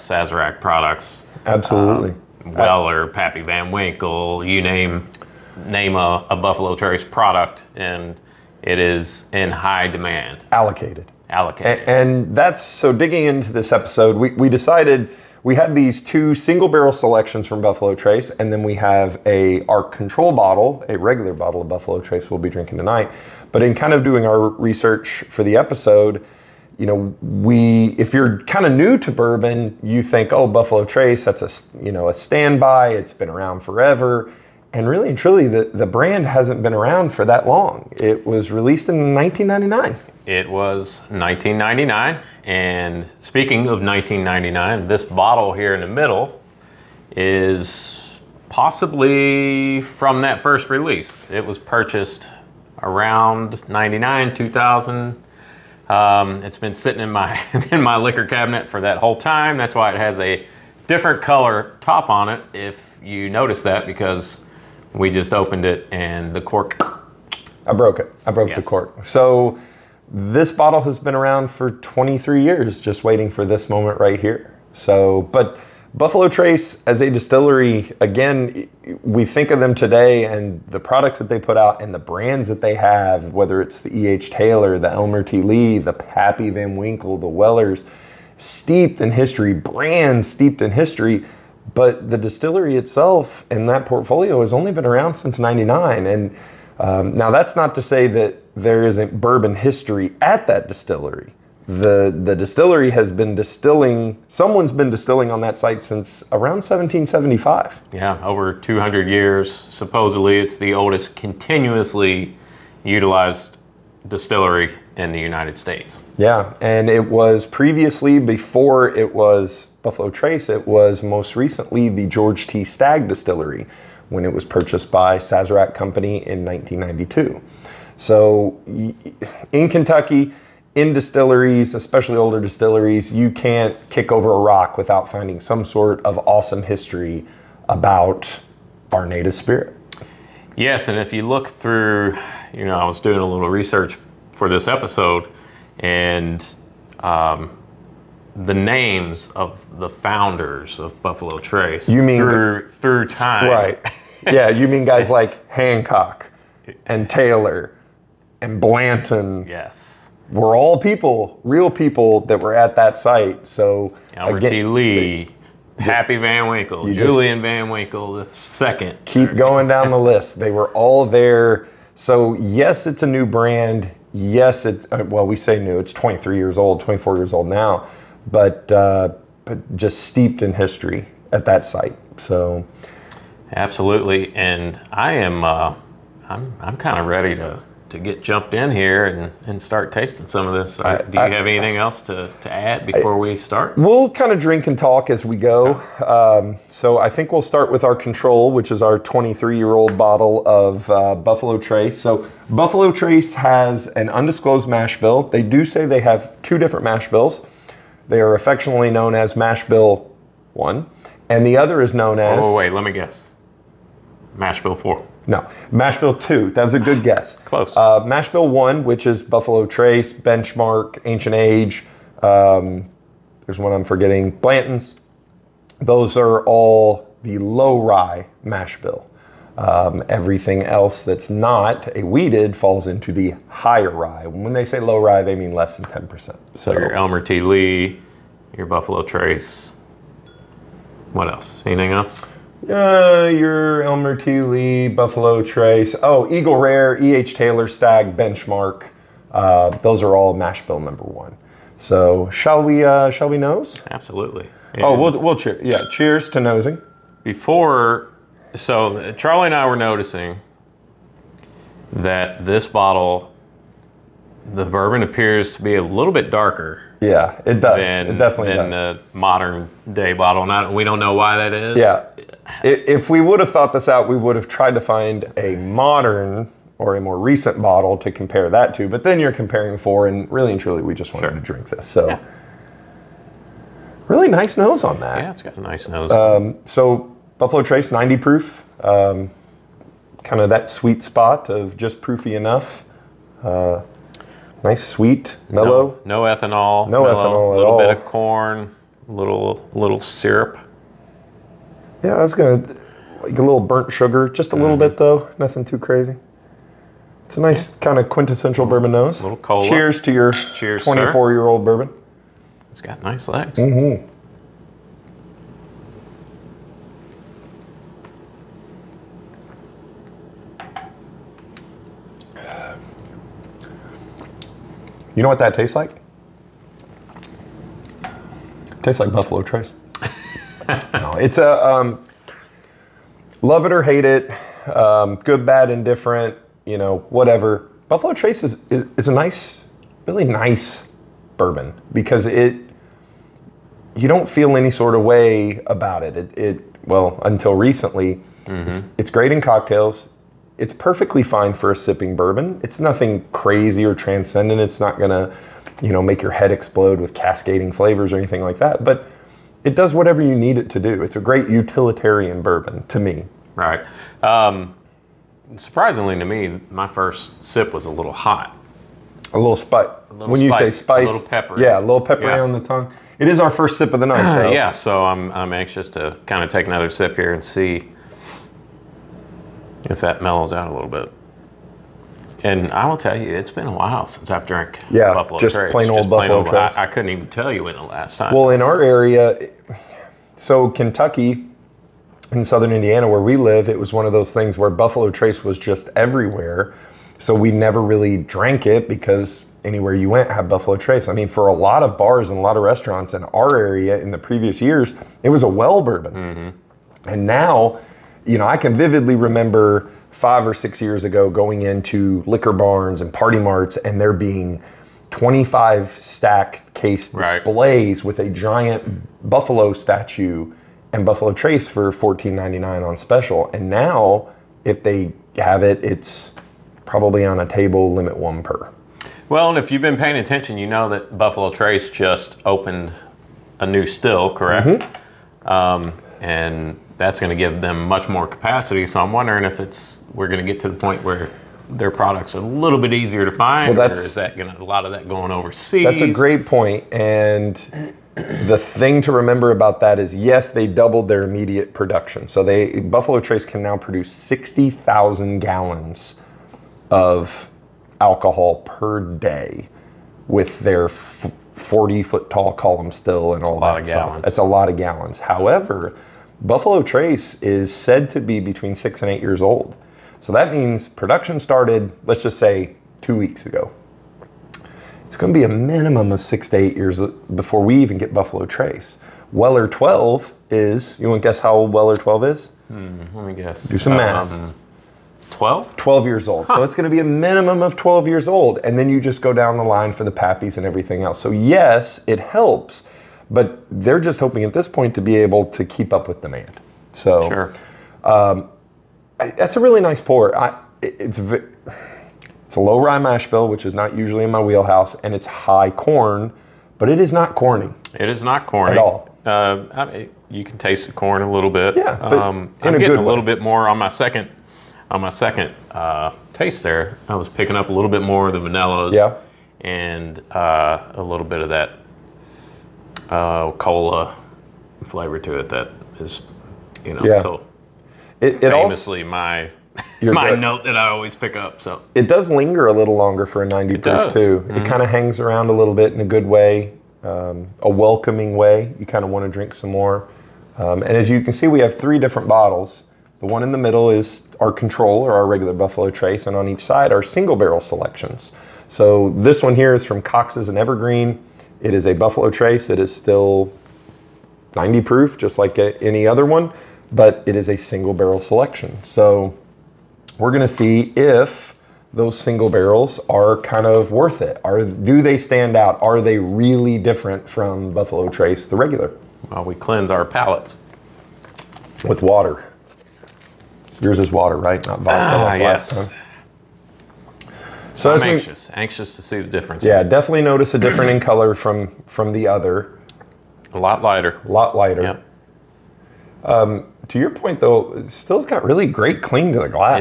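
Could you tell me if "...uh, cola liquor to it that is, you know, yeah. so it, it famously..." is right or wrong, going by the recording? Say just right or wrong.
wrong.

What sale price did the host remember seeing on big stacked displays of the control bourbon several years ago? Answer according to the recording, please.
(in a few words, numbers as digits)
$14.99.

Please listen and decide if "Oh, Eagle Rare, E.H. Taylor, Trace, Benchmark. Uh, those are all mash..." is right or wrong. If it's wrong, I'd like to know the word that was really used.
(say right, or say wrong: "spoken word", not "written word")
wrong: "Stagg", not "Trace".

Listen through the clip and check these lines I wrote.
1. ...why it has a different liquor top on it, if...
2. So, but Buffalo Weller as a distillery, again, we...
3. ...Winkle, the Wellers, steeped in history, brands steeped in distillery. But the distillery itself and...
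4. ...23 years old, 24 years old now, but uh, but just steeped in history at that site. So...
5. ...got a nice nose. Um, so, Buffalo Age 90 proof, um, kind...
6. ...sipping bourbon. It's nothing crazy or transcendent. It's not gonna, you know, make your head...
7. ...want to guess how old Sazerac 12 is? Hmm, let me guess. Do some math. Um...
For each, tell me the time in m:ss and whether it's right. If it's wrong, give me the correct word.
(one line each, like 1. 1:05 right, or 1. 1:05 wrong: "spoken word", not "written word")
1. 0:59 wrong: "color", not "liquor"
2. 1:14 wrong: "Trace", not "Weller"
3. 1:26 wrong: "history", not "distillery"
4. 2:55 right
5. 4:45 wrong: "Trace", not "Age"
6. 5:51 right
7. 8:01 wrong: "Weller", not "Sazerac".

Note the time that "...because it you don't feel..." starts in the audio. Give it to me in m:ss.
5:41.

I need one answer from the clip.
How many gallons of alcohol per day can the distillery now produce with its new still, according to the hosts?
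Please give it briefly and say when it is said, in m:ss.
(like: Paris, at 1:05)
60,000, at 7:34.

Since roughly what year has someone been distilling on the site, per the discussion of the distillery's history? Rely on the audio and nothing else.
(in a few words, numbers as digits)
1775.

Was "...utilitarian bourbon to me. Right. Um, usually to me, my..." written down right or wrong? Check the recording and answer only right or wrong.
wrong.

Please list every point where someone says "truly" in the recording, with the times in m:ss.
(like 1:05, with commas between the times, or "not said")
0:35, 4:40.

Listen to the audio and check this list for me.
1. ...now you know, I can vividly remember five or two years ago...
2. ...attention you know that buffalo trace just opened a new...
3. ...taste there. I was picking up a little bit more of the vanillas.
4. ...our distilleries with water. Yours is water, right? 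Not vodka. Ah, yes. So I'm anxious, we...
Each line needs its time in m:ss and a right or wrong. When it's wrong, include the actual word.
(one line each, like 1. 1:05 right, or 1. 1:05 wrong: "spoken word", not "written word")
1. 6:47 wrong: "six", not "two"
2. 7:10 right
3. 8:36 right
4. 9:29 wrong: "palates", not "distilleries".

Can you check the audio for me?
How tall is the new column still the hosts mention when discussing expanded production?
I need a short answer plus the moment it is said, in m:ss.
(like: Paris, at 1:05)
40 feet, at 7:40.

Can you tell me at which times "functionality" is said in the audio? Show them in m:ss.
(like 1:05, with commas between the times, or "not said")
not said.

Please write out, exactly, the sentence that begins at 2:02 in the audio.
Stagg Distillery when it was purchased by Sazerac Company in 1992.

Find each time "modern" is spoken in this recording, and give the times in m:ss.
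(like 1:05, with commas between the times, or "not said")
4:29, 4:35.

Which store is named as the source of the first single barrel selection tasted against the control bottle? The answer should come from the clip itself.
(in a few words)
Cox's.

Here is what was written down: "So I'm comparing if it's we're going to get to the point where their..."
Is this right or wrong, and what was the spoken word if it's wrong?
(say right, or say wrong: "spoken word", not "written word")
wrong: "wondering", not "comparing".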